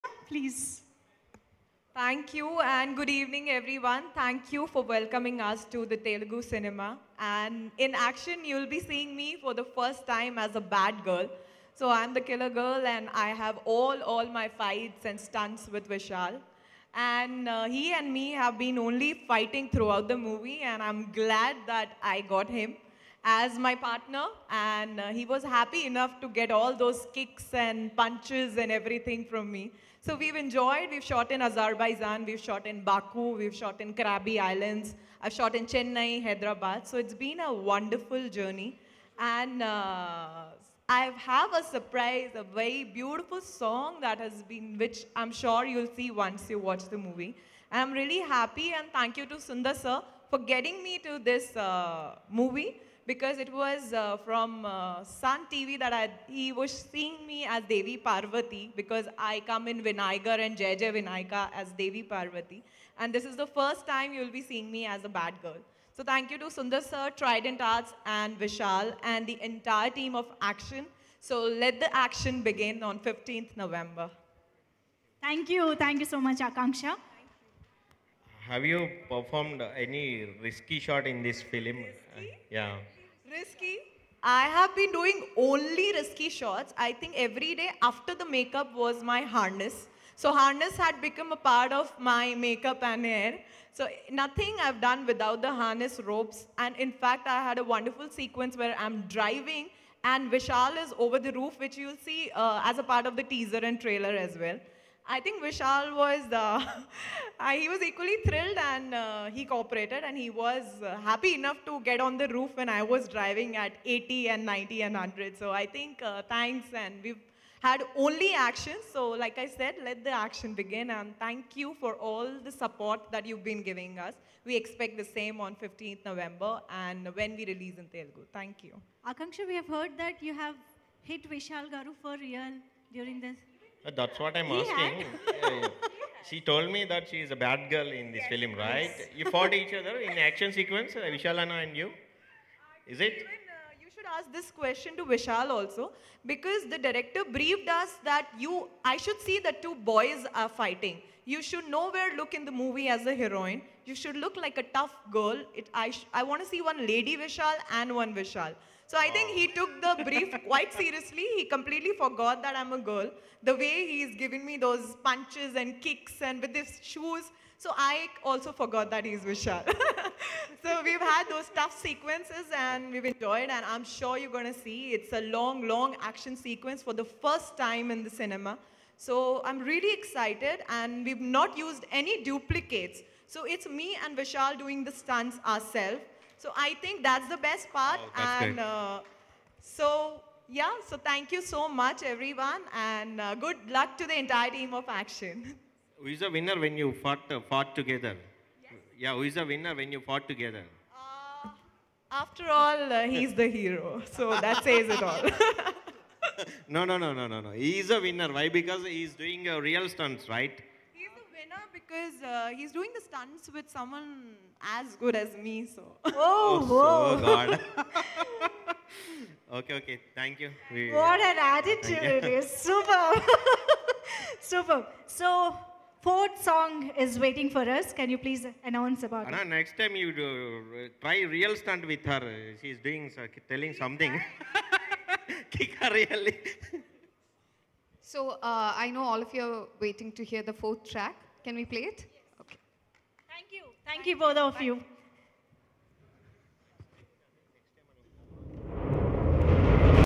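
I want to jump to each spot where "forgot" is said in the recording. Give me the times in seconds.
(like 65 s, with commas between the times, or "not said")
161 s, 168 s.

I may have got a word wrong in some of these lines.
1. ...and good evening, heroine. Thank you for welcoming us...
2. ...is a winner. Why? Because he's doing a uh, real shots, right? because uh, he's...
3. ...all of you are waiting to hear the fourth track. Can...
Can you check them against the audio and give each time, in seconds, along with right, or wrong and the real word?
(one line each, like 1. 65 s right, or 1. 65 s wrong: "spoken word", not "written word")
1. 2 s wrong: "everyone", not "heroine"
2. 207 s wrong: "stunts", not "shots"
3. 239 s right.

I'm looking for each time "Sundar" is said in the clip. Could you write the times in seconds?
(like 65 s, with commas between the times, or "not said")
49 s, 66 s.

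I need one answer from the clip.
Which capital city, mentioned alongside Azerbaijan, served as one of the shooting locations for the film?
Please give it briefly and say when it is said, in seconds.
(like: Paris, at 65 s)
Baku, at 32 s.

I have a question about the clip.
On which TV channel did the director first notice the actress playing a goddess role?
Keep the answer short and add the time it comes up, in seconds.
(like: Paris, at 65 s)
Sun TV, at 55 s.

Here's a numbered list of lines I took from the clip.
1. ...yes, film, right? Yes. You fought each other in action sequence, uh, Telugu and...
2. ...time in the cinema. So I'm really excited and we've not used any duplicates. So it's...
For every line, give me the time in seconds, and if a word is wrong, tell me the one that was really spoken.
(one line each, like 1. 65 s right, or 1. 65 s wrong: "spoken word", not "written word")
1. 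138 s wrong: "Vishalana", not "Telugu"
2. 177 s right.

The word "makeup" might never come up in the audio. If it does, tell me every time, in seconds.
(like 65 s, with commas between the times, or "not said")
88 s, 92 s.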